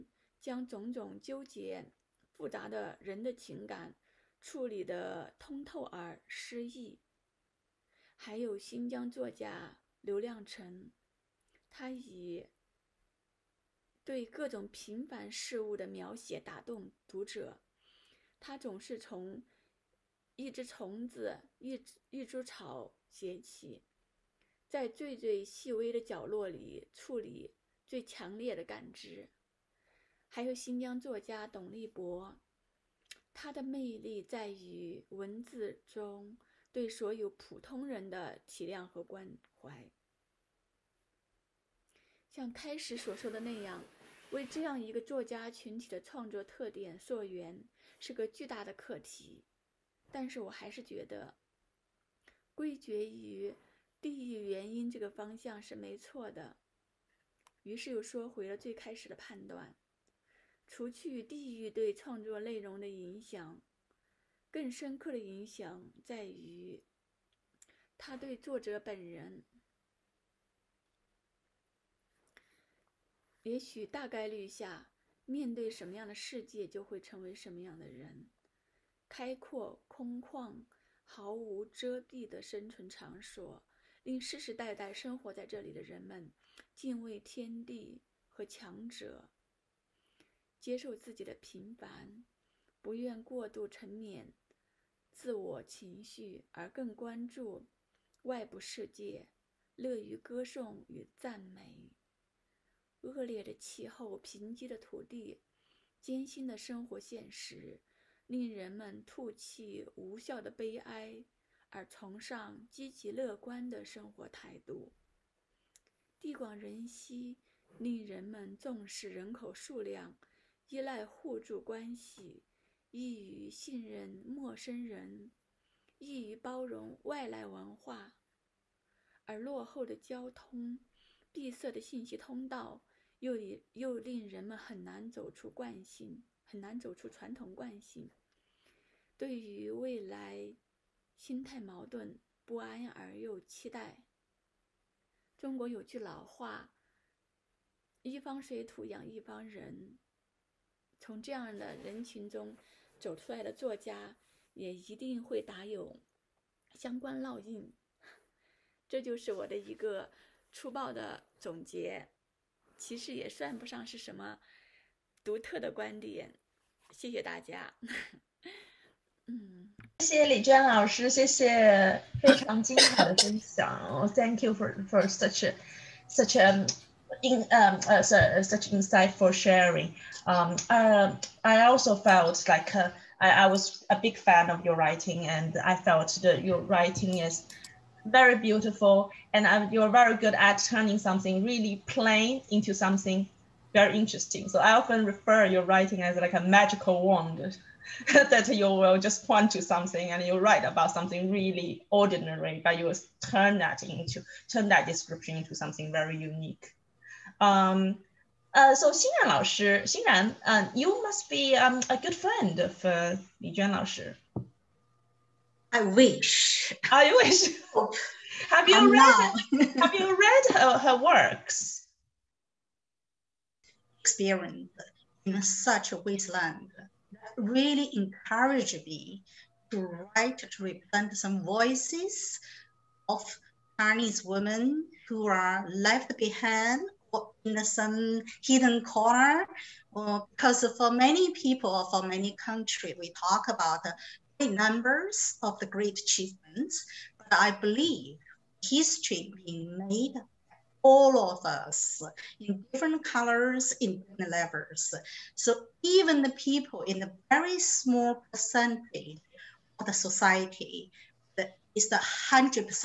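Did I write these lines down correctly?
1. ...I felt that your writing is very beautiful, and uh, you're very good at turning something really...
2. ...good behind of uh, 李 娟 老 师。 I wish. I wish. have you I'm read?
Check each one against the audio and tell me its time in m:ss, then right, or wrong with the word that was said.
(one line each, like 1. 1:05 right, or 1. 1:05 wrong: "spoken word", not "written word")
1. 3:05 right
2. 3:31 wrong: "friend", not "behind".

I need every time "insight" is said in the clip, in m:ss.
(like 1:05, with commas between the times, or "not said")
2:58.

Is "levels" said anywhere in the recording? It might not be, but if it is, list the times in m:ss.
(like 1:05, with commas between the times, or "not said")
4:14.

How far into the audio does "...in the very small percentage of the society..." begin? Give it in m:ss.
4:16.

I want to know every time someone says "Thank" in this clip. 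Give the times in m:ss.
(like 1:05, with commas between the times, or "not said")
2:54.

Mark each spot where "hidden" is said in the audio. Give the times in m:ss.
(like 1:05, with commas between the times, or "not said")
3:58.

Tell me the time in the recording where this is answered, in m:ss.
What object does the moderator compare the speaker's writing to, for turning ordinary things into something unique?
3:16.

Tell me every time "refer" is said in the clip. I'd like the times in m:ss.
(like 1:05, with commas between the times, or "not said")
3:15.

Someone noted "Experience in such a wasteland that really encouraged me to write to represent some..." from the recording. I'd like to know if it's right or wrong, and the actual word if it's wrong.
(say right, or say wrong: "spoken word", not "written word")
right.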